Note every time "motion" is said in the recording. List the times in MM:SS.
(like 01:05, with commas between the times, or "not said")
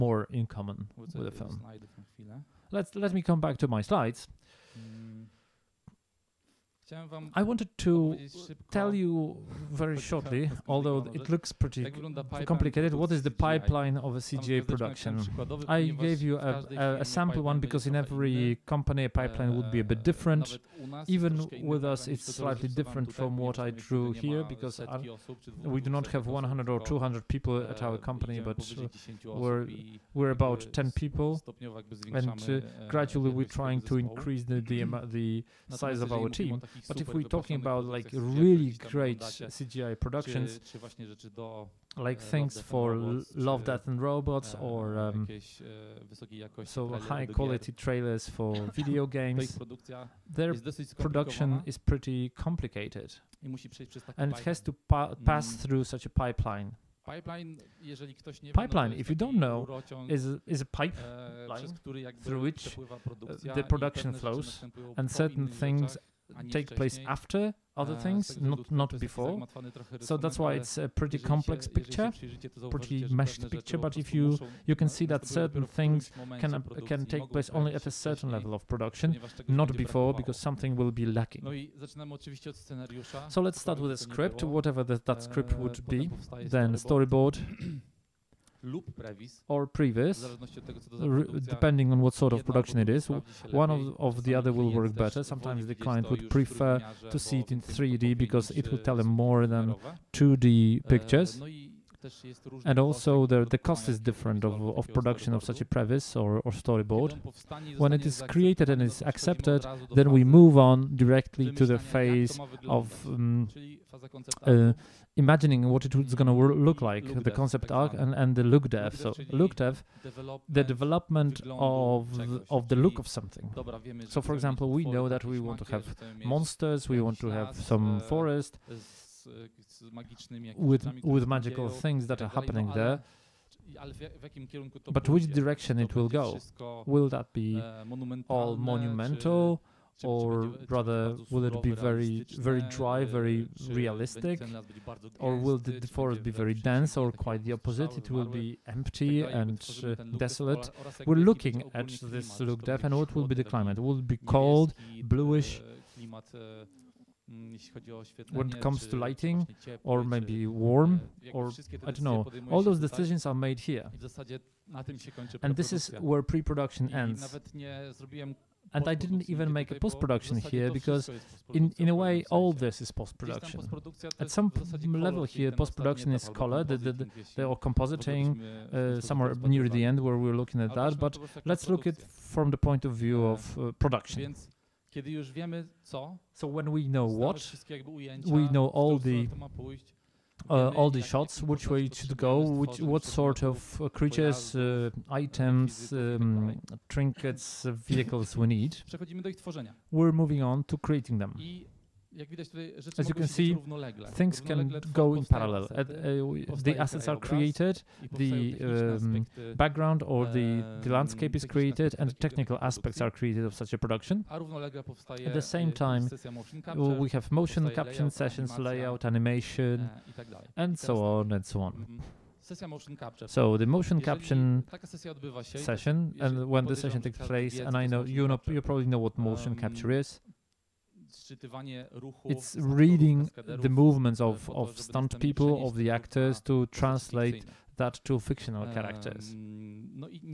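03:37, 03:43, 03:49.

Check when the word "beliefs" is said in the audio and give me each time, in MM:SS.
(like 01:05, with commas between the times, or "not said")
not said.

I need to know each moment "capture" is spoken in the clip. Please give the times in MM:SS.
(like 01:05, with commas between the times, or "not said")
03:37, 03:44, 03:49.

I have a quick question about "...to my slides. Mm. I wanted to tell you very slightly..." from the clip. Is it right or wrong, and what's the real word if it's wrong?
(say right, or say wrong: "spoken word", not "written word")
wrong: "shortly", not "slightly".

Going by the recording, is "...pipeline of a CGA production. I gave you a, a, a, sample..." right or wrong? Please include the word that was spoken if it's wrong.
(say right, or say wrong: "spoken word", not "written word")
right.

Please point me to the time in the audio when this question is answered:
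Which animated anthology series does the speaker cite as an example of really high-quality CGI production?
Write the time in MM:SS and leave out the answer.
00:43.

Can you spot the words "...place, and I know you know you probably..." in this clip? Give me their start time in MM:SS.
03:47.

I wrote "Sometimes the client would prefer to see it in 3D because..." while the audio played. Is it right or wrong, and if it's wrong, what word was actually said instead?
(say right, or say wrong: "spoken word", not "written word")
right.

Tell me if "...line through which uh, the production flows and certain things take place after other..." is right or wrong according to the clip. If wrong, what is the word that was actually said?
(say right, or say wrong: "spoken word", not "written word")
right.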